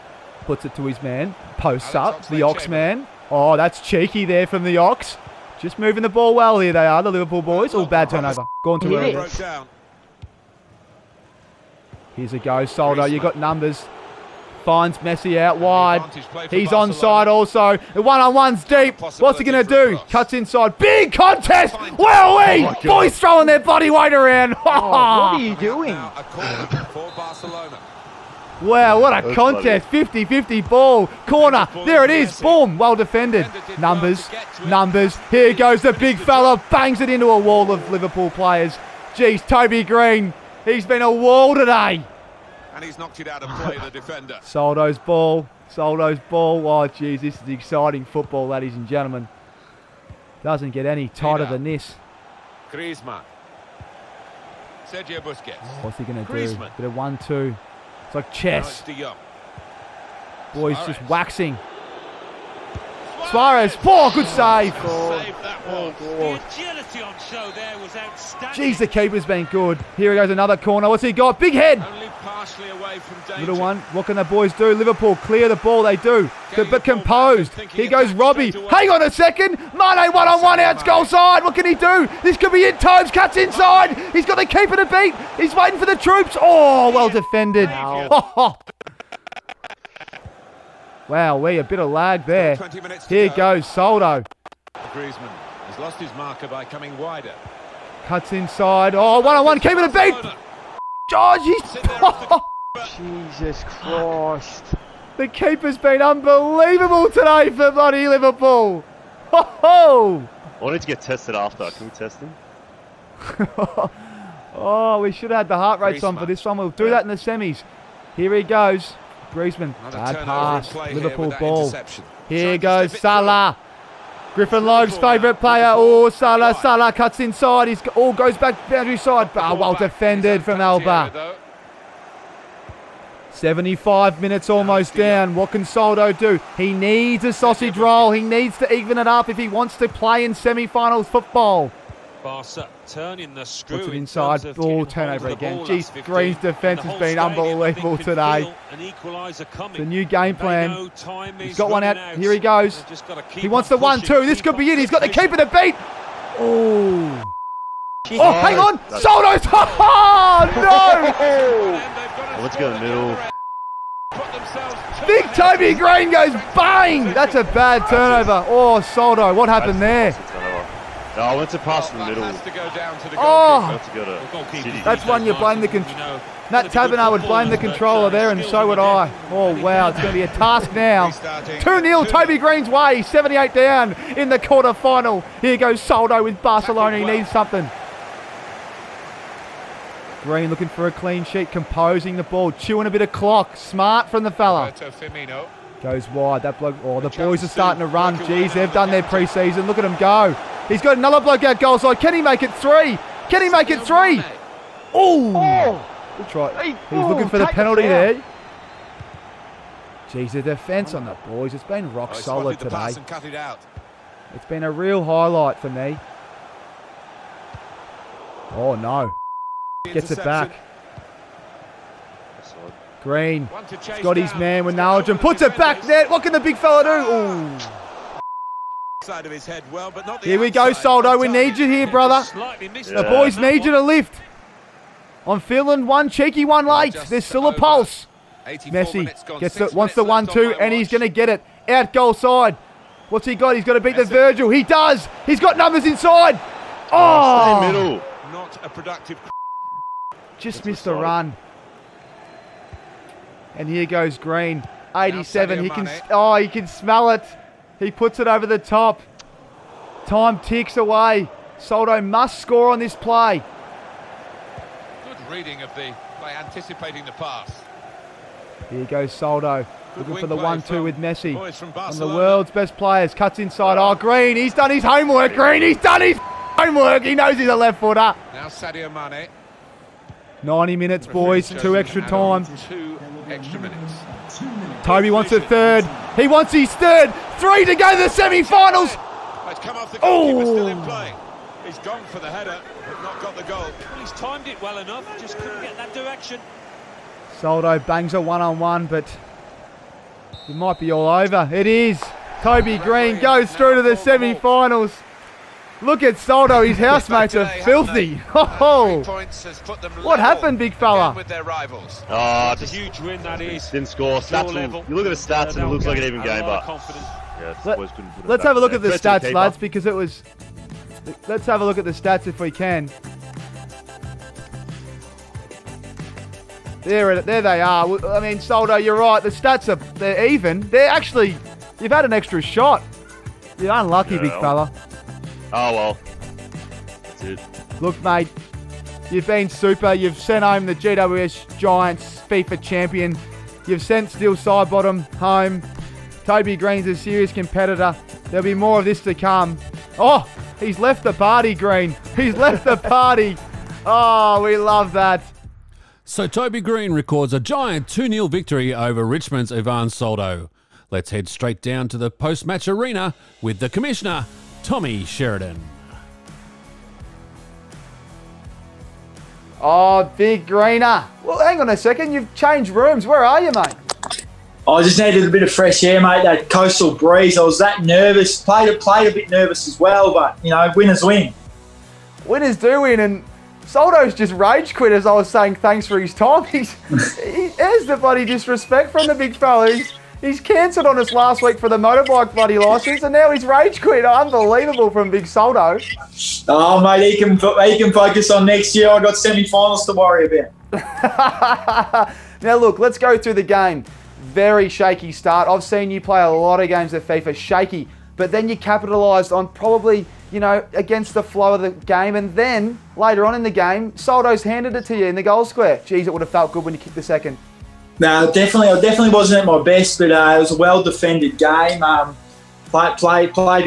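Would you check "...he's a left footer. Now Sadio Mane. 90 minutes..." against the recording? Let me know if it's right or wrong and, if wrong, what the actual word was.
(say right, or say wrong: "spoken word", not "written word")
right.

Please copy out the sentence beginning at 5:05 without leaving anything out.
Look at Soldo, his housemates are filthy.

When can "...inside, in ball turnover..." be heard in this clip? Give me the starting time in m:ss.
2:23.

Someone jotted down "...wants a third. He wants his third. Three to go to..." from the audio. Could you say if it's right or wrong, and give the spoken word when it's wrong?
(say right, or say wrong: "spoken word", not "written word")
right.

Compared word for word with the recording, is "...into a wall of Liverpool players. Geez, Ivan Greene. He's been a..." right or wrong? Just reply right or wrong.
wrong.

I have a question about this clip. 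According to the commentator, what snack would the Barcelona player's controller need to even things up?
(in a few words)
A sausage roll.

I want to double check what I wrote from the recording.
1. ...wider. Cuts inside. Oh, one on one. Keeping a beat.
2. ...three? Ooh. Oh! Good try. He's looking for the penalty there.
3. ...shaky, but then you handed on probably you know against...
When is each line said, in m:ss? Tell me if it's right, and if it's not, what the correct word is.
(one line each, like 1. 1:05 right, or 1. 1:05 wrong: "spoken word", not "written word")
1. 1:36 right
2. 3:23 right
3. 6:47 wrong: "capitalised", not "handed".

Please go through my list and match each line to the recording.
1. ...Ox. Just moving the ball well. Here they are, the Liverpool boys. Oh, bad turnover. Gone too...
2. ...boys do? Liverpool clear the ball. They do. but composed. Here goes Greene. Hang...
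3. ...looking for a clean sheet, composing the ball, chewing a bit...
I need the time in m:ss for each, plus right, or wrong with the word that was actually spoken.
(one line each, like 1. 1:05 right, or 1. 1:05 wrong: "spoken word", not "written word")
1. 0:04 right
2. 1:14 wrong: "Robbie", not "Greene"
3. 3:10 right.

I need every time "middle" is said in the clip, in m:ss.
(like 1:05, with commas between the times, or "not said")
2:42, 2:52, 4:07.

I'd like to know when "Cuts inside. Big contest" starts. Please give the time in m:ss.
0:20.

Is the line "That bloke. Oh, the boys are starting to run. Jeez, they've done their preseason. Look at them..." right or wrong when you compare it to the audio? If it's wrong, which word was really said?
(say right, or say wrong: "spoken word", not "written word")
right.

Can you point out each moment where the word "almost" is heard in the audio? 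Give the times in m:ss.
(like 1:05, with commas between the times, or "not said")
2:14.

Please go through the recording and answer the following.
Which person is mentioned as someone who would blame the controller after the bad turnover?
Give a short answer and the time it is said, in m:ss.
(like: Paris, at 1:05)
Taberner, at 2:56.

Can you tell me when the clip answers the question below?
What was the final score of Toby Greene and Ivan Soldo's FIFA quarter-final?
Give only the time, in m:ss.
5:57.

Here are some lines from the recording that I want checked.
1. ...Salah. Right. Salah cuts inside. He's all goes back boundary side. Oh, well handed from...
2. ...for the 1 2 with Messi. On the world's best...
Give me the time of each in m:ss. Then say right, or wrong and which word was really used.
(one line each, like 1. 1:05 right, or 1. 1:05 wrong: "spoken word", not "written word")
1. 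2:06 wrong: "defended", not "handed"
2. 4:30 right.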